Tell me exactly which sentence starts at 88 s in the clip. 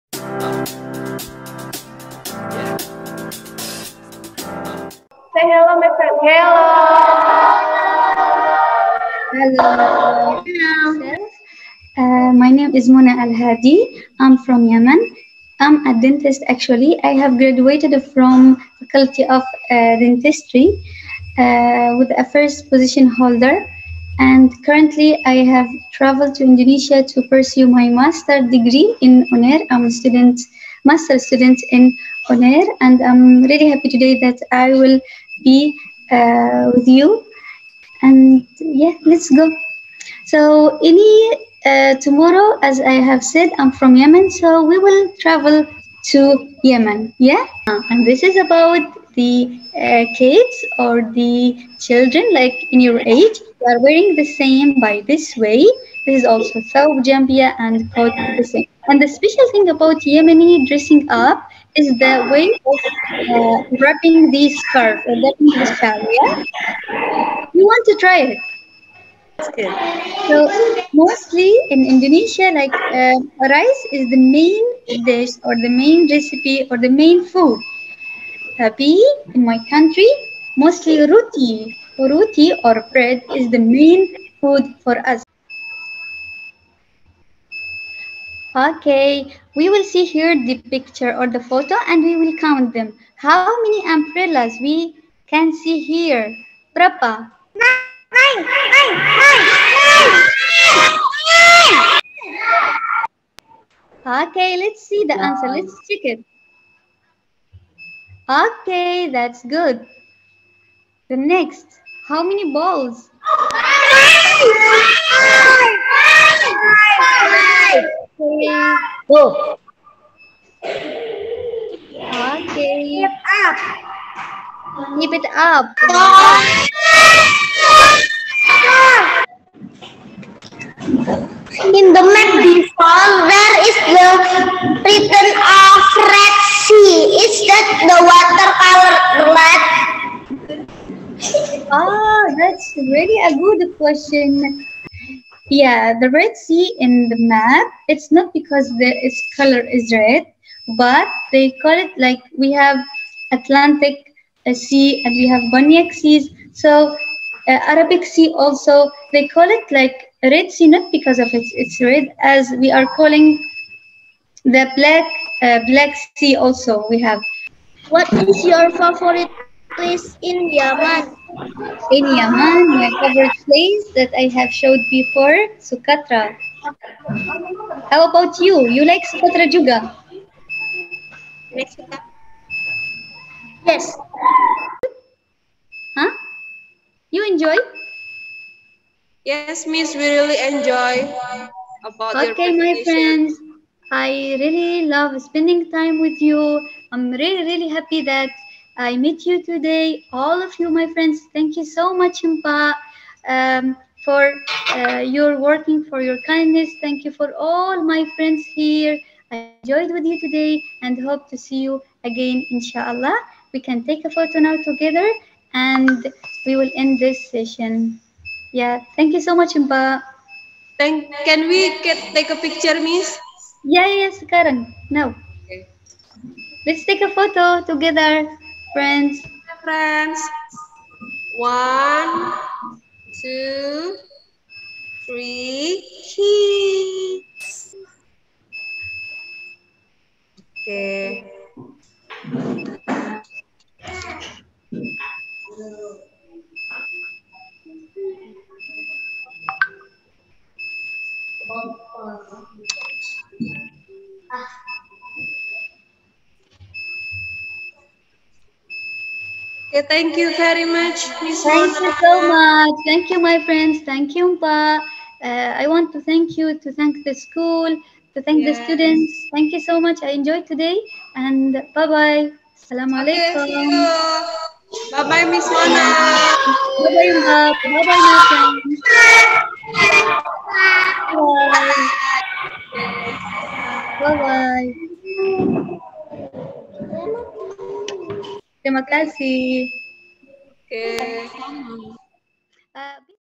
Okay, we will see here the picture or the photo and we will count them.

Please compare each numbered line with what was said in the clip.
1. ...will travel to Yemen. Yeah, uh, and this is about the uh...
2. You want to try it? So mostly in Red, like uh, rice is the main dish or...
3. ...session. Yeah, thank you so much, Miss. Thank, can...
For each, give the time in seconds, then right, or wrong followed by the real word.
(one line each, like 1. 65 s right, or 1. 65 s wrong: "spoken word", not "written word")
1. 44 s right
2. 67 s wrong: "Indonesia", not "Red"
3. 217 s wrong: "Impa", not "Miss".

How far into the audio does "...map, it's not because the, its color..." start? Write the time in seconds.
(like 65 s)
147 s.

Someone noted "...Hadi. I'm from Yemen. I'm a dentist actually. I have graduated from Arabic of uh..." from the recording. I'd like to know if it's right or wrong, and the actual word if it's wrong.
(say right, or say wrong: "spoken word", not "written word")
wrong: "Faculty", not "Arabic".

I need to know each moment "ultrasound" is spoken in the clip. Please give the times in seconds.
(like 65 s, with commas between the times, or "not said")
not said.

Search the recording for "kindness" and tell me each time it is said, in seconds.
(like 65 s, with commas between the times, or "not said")
206 s.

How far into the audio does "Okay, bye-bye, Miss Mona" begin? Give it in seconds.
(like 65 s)
273 s.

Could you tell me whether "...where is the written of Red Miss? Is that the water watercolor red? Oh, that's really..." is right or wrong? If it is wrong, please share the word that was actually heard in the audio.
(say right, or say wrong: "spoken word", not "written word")
wrong: "Sea", not "Miss".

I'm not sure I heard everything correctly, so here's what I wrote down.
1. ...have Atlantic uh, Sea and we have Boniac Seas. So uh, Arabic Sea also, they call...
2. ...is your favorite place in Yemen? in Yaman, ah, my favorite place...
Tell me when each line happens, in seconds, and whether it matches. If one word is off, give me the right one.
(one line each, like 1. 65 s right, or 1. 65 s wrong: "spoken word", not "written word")
1. 152 s right
2. 168 s right.